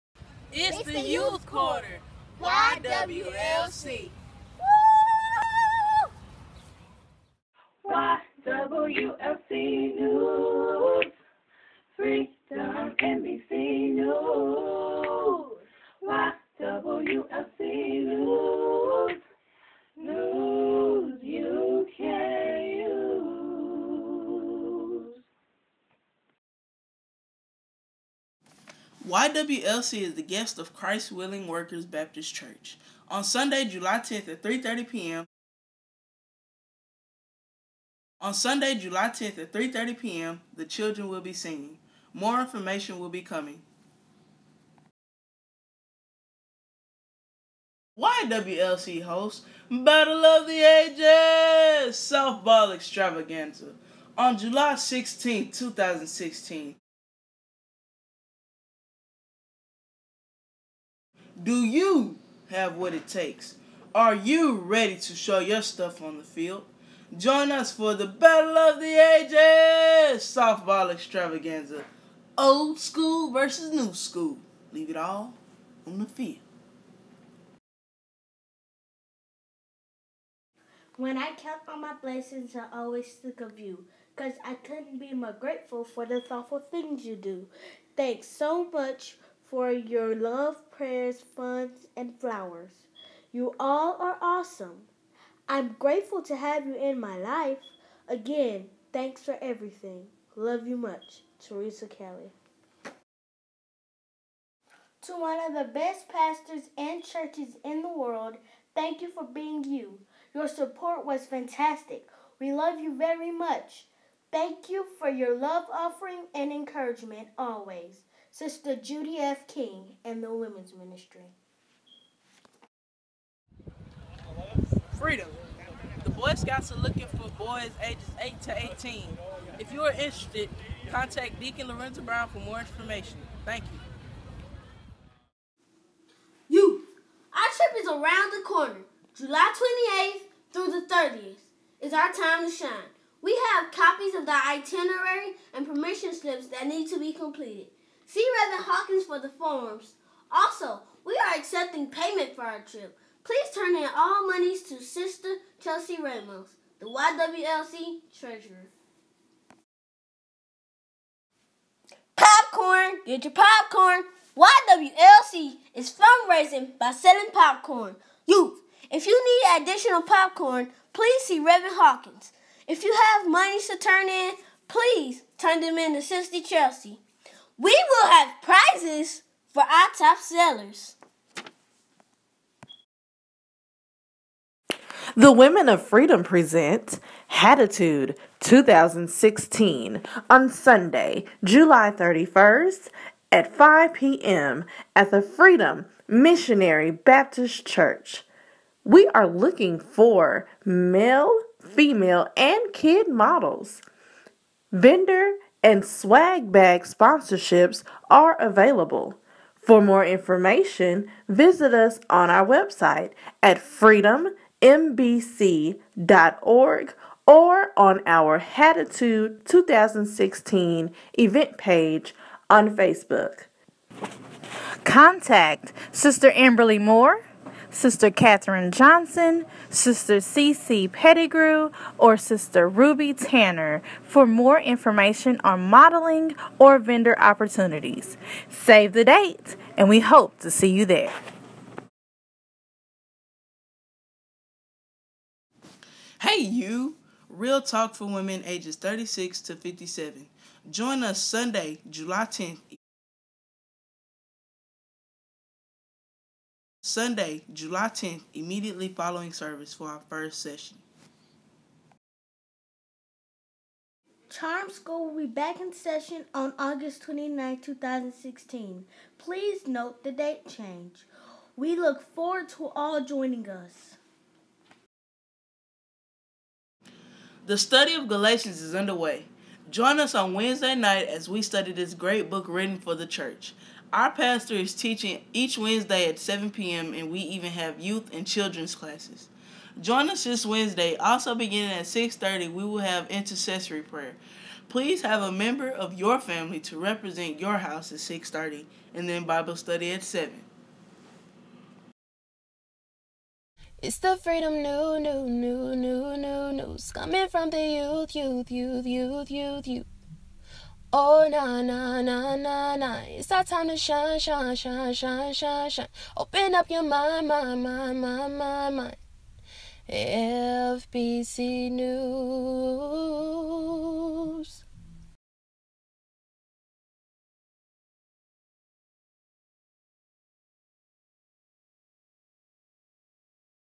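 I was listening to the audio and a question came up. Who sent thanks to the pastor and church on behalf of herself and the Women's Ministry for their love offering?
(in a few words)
Judy F. King.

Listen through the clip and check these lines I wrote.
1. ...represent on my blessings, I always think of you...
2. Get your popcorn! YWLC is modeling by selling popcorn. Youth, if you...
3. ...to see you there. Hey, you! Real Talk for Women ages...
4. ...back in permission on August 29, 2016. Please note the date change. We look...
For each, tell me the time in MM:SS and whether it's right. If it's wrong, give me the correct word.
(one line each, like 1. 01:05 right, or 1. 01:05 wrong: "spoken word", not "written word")
1. 01:21 wrong: "count", not "represent"
2. 02:43 wrong: "fundraising", not "modeling"
3. 04:00 right
4. 04:25 wrong: "session", not "permission".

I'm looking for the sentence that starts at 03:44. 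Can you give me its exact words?
Contact Sister Amberly Moore Sister Catherine Johnson, Sister CC Pettigrew, or Sister Ruby Tanner for more information on modeling or vendor opportunities.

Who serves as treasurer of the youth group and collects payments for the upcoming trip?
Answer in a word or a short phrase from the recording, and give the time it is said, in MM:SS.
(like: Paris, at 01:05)
Chelsea Ramos, at 02:35.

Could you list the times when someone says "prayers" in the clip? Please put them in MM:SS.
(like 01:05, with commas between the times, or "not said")
01:30, 04:53.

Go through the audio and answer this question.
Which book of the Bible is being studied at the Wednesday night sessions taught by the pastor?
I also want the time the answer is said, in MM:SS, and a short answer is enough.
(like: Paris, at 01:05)
Galatians, at 04:38.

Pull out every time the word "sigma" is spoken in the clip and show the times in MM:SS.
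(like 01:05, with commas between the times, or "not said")
not said.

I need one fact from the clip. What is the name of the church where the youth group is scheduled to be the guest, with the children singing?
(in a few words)
Christ Willing Workers Baptist Church.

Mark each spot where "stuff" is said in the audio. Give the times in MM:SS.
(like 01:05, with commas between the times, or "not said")
01:05.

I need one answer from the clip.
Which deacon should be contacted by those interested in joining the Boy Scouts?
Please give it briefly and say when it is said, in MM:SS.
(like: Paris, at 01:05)
Lorenzo Brown, at 02:11.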